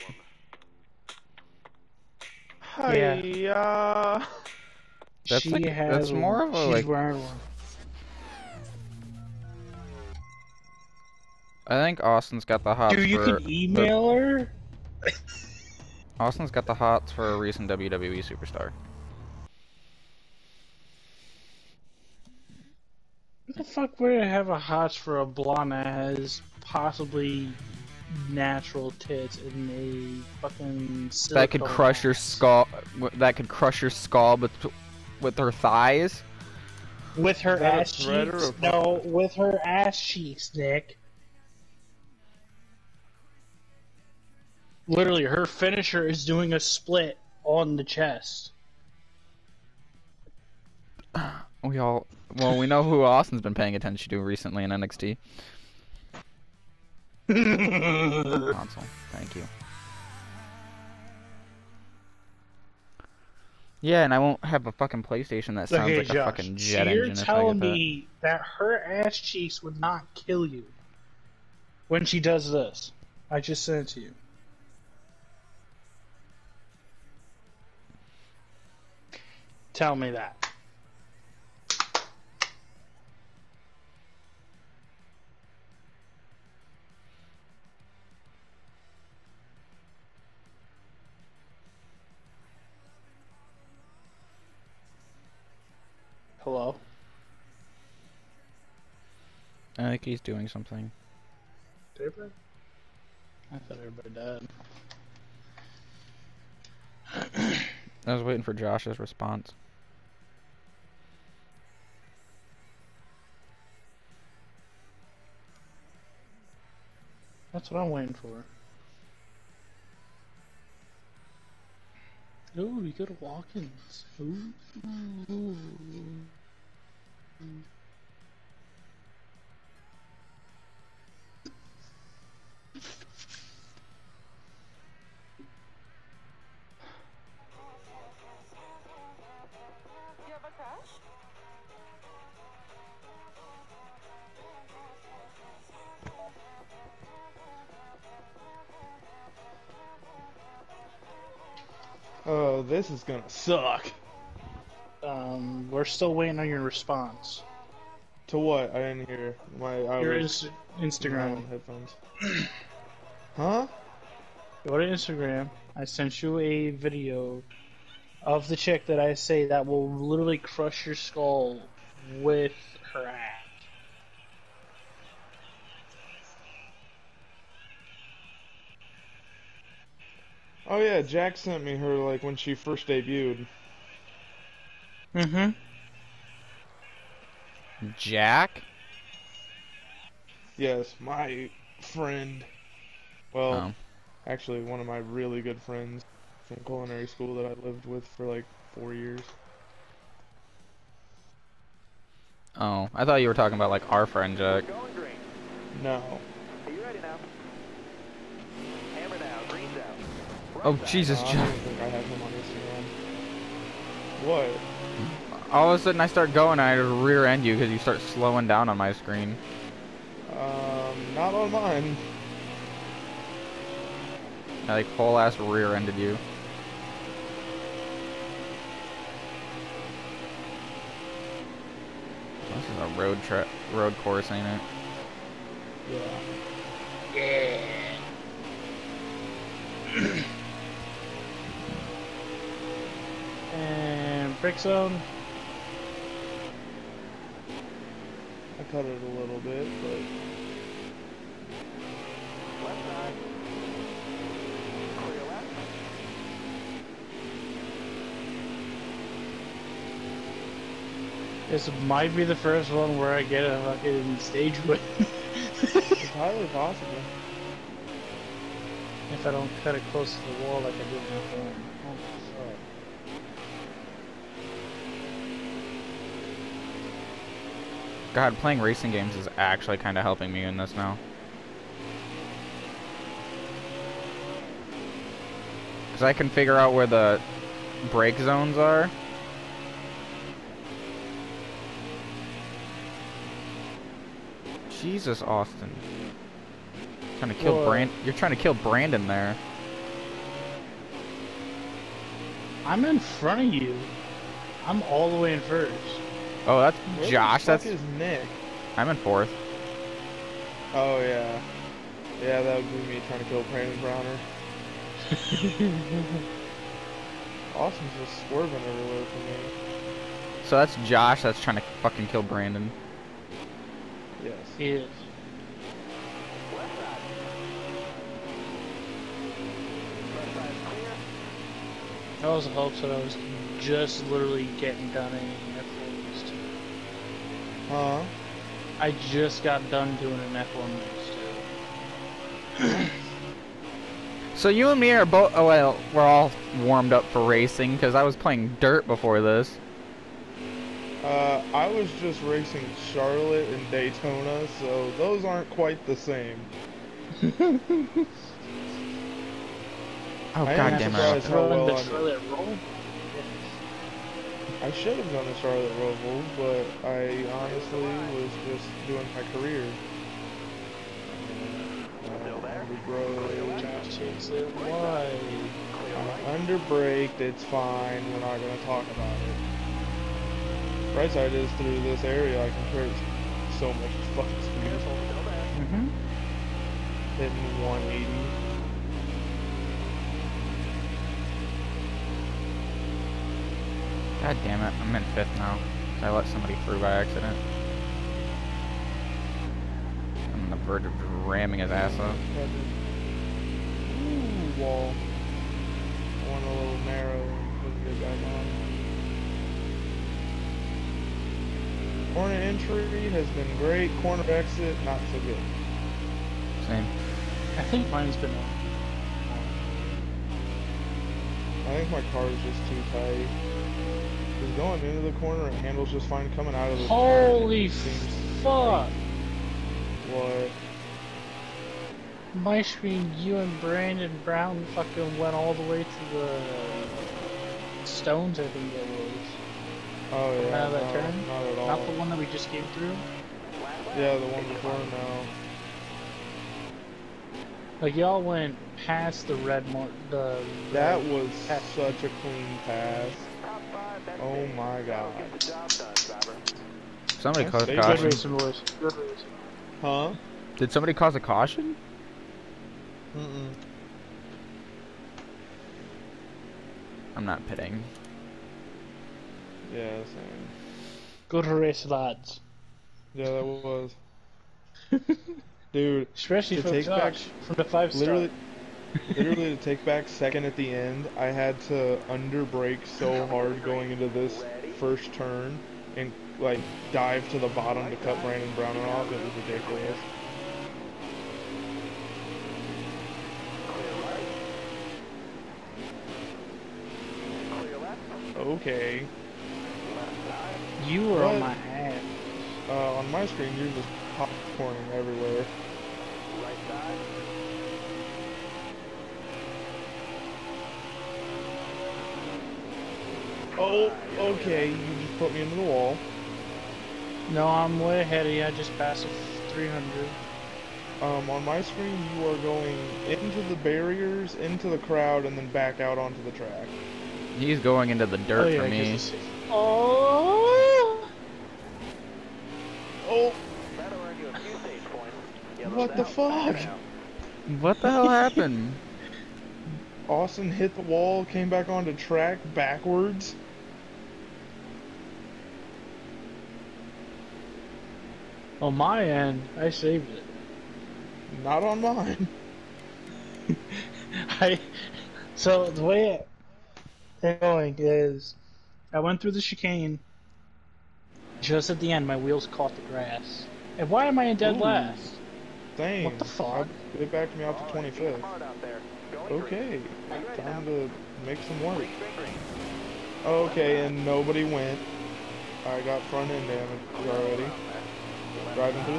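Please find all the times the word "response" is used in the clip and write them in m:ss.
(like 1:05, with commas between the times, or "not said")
1:48, 2:36.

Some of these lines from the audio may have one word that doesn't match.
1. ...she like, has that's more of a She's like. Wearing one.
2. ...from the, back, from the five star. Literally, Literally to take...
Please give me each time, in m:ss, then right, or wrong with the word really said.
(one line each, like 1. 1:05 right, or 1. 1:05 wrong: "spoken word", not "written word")
1. 0:05 right
2. 7:56 right.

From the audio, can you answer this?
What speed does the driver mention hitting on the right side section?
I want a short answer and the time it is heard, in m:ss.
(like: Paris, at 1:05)
180, at 6:27.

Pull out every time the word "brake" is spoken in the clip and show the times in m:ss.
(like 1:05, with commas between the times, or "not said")
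4:47, 6:16.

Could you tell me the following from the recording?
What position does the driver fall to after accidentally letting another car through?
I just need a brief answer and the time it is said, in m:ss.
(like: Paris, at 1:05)
Fifth, at 6:35.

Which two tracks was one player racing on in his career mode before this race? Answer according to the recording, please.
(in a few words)
Charlotte and Daytona.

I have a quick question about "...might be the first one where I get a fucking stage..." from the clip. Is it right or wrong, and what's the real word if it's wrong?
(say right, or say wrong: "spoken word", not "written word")
right.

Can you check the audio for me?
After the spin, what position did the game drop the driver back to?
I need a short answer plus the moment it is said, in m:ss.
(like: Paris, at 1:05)
25th, at 9:27.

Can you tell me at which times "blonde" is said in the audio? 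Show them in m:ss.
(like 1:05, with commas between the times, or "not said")
0:25.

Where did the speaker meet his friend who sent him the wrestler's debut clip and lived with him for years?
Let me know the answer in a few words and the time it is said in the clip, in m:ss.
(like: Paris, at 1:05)
Culinary school, at 3:16.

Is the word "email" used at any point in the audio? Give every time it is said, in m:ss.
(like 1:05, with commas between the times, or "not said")
0:13.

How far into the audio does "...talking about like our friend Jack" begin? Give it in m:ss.
3:23.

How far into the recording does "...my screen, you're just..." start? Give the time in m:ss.
8:23.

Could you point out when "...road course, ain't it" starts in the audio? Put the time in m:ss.
3:53.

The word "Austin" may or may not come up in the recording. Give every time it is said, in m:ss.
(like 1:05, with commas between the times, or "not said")
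0:12, 0:16, 0:53, 4:55, 5:17, 9:00.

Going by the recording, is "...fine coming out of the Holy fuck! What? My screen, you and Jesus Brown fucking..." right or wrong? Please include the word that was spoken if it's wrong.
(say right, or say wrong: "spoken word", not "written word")
wrong: "Brandon", not "Jesus".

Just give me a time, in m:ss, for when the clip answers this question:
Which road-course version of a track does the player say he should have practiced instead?
6:05.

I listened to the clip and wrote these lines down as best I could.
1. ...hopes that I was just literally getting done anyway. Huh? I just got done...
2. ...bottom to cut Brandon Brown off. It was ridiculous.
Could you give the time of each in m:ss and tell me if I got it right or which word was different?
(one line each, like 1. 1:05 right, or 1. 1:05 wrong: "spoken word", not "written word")
1. 5:32 right
2. 8:07 right.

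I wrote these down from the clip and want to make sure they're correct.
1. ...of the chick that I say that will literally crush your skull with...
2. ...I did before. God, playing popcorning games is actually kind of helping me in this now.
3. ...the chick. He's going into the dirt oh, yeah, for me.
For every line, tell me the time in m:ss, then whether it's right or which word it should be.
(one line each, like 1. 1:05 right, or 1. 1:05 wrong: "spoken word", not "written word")
1. 2:48 right
2. 4:30 wrong: "racing", not "popcorning"
3. 8:46 wrong: "track", not "chick".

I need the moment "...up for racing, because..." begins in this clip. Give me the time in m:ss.
5:46.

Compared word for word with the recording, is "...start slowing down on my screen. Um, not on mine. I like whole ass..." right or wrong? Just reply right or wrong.
right.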